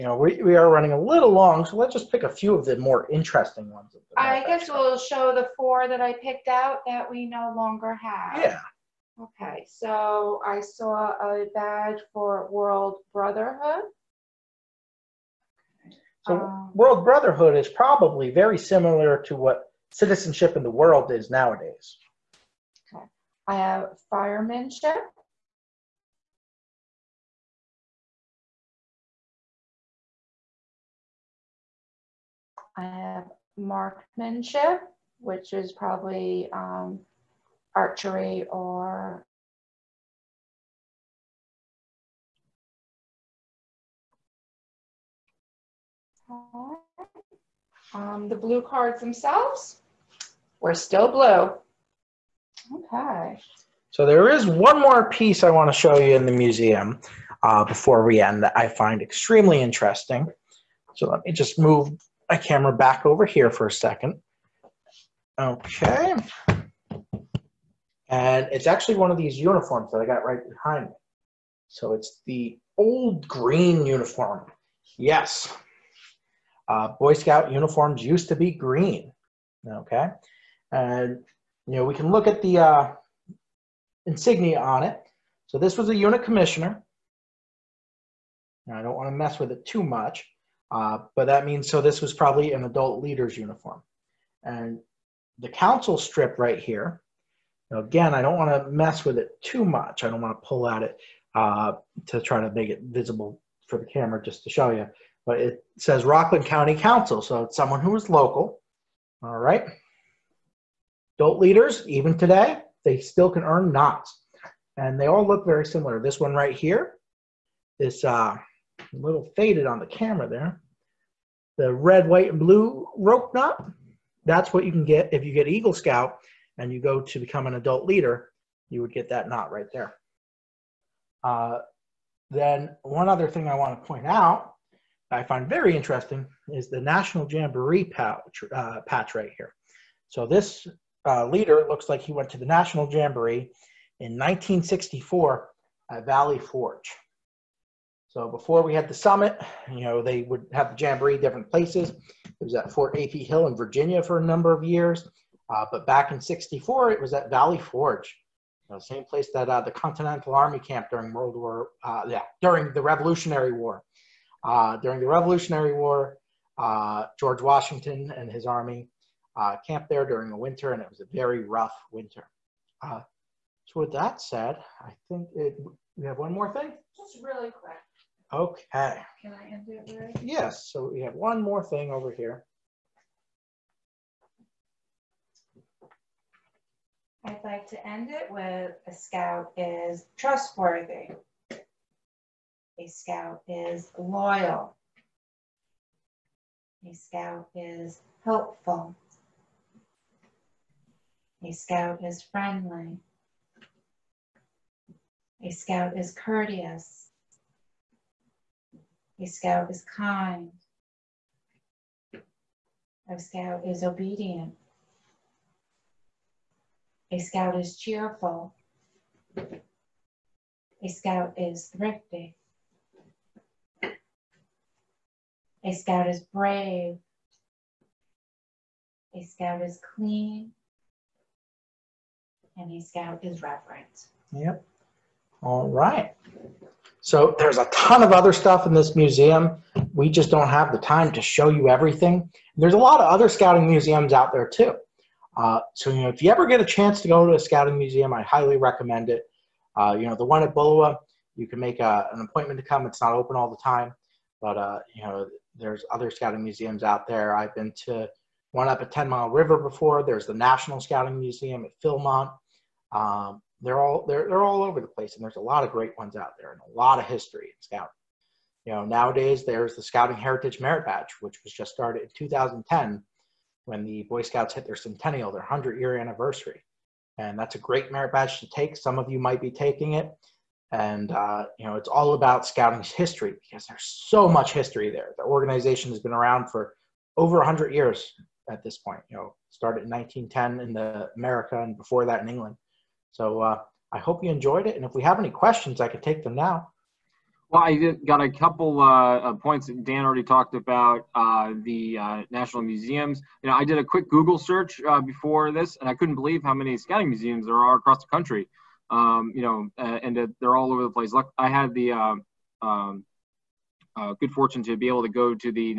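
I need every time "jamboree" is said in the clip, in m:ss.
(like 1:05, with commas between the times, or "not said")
2:17, 2:22, 2:30.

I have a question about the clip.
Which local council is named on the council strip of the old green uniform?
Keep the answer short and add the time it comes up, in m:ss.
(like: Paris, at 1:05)
Rockland County Council, at 1:46.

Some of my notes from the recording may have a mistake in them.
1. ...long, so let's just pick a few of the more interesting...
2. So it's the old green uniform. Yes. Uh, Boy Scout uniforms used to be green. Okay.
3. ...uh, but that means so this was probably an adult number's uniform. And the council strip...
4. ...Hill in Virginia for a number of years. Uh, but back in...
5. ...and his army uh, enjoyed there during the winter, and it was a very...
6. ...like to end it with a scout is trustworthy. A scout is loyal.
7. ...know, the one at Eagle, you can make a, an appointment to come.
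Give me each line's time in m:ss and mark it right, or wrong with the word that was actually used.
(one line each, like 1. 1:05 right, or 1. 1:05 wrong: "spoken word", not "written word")
1. 0:01 right
2. 1:11 right
3. 1:30 wrong: "leader", not "number"
4. 2:33 right
5. 2:48 wrong: "camped", not "enjoyed"
6. 3:07 right
7. 4:10 wrong: "Bullowa", not "Eagle".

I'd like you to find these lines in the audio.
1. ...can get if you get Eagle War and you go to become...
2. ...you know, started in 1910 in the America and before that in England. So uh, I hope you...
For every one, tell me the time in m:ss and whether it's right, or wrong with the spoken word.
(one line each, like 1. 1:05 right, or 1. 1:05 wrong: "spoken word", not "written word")
1. 2:04 wrong: "Scout", not "War"
2. 4:49 right.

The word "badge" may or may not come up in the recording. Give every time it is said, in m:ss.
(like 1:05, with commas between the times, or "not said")
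0:11, 4:30, 4:38.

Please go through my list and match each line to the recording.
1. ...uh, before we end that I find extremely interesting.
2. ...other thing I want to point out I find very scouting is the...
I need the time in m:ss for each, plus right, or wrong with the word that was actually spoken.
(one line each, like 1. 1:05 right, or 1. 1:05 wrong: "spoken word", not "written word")
1. 0:57 right
2. 2:13 wrong: "interesting", not "scouting".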